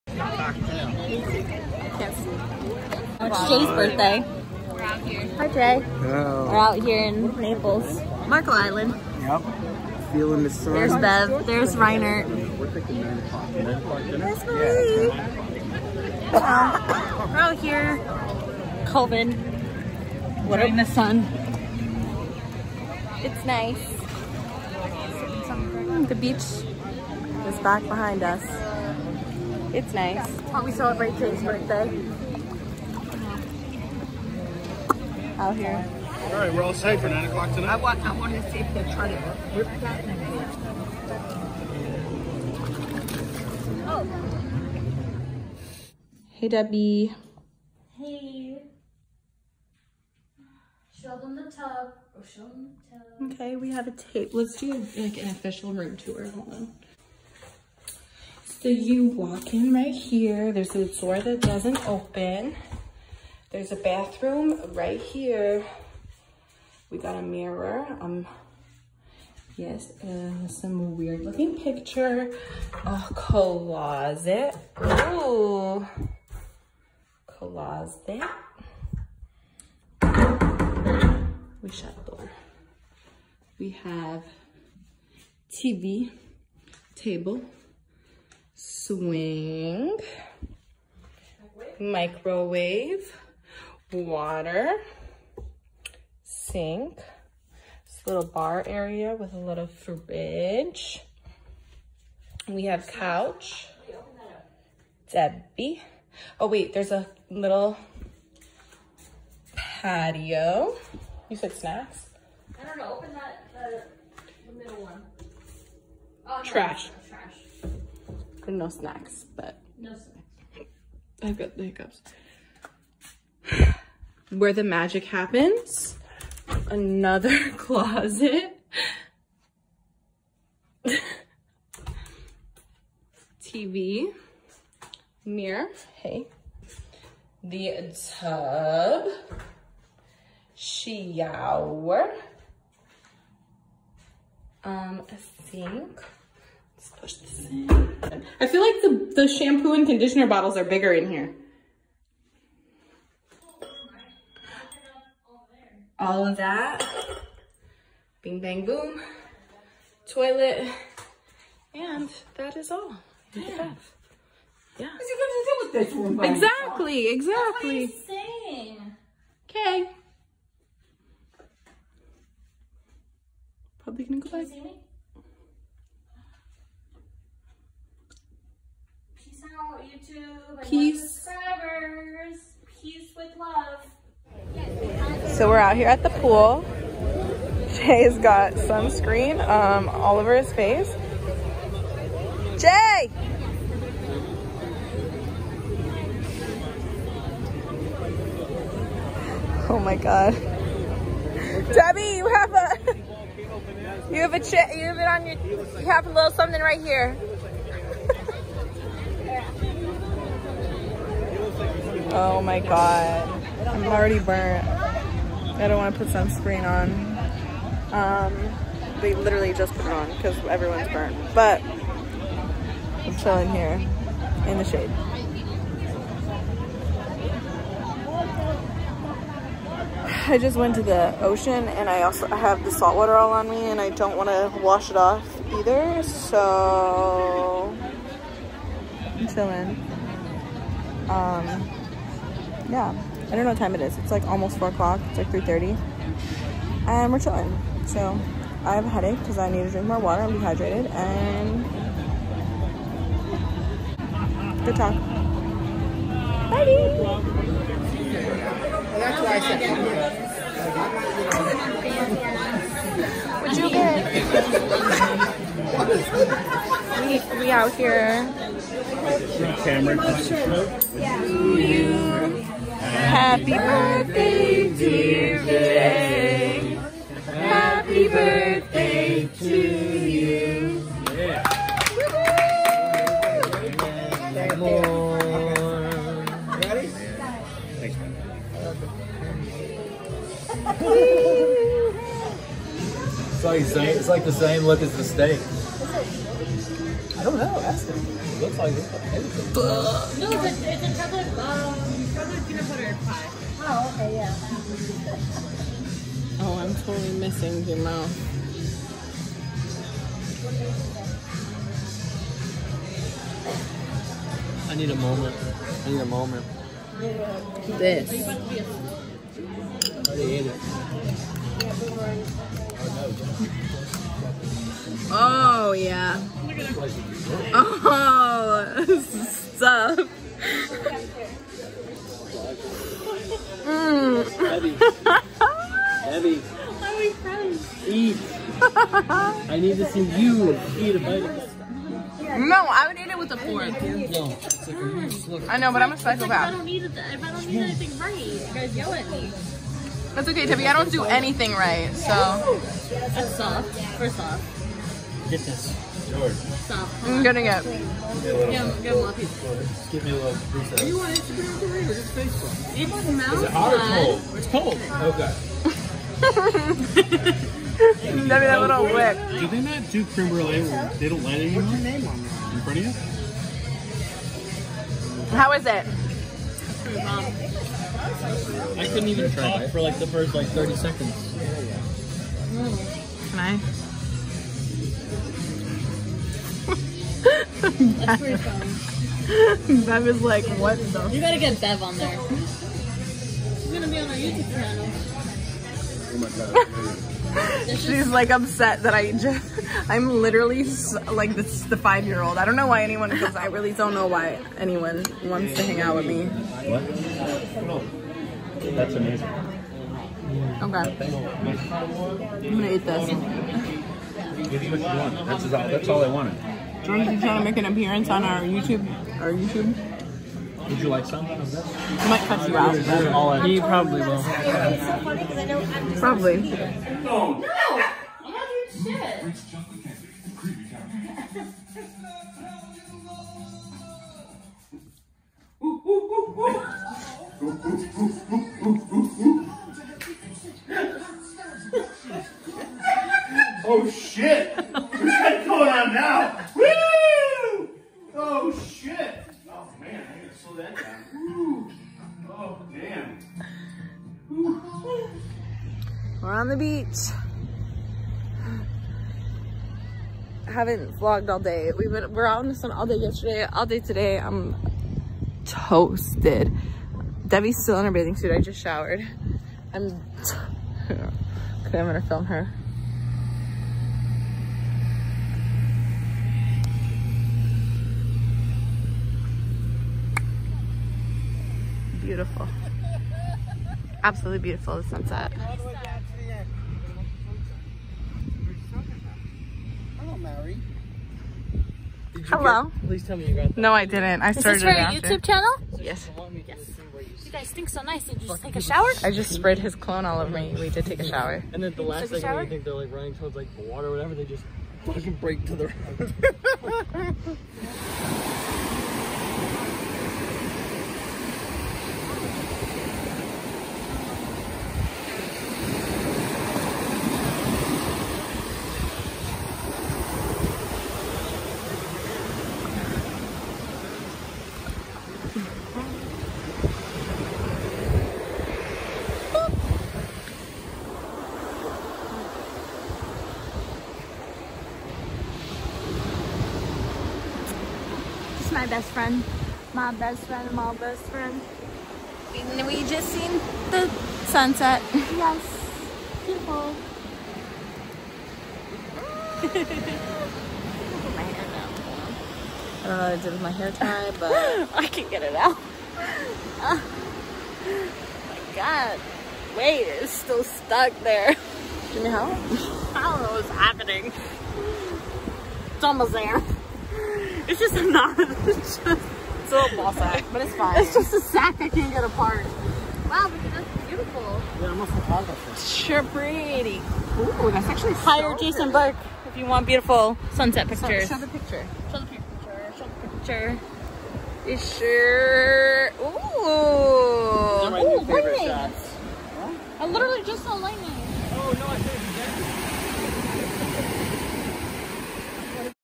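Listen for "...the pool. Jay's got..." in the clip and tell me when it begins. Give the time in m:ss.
3:06.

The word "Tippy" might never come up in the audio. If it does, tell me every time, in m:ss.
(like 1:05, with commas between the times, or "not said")
5:50.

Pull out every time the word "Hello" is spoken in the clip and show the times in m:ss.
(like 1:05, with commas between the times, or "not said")
0:05, 8:12.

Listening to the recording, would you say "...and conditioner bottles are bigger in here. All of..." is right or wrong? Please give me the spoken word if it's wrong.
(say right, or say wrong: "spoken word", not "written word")
right.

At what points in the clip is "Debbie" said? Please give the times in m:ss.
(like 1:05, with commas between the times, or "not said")
0:46, 1:45, 3:21, 7:47.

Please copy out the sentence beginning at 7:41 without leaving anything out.
We been we're out in the sun all day yesterday, all day today.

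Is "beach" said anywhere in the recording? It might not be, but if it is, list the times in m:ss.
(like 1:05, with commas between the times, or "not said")
0:26, 7:36.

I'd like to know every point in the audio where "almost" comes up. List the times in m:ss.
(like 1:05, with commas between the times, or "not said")
4:04, 9:25.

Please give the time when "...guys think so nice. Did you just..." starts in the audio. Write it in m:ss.
8:17.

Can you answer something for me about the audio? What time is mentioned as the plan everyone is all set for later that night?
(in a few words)
9 o'clock.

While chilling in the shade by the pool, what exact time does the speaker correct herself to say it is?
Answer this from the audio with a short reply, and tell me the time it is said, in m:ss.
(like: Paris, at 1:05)
3:30, at 4:05.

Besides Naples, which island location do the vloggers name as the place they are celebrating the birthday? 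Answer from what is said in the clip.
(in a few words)
Marco Island.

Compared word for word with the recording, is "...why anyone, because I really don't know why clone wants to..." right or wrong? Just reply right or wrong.
wrong.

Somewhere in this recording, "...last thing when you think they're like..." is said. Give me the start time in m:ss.
8:21.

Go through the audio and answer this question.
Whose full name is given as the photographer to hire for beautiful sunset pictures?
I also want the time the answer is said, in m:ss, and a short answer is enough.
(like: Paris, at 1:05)
Jason Burke, at 9:38.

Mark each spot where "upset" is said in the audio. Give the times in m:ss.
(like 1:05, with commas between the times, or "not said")
6:38.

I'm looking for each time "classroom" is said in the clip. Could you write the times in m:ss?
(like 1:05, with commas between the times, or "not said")
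not said.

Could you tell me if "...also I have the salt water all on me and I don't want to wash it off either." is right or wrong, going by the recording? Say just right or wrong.
right.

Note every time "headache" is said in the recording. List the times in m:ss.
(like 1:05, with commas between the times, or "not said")
4:08.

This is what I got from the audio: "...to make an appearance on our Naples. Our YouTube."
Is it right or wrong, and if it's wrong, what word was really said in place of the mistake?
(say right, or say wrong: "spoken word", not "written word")
wrong: "YouTube", not "Naples".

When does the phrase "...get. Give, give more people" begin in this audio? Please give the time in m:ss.
5:57.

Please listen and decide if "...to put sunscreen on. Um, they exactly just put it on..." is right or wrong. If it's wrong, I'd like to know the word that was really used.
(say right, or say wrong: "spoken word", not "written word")
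wrong: "literally", not "exactly".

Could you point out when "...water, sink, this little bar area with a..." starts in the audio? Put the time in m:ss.
1:33.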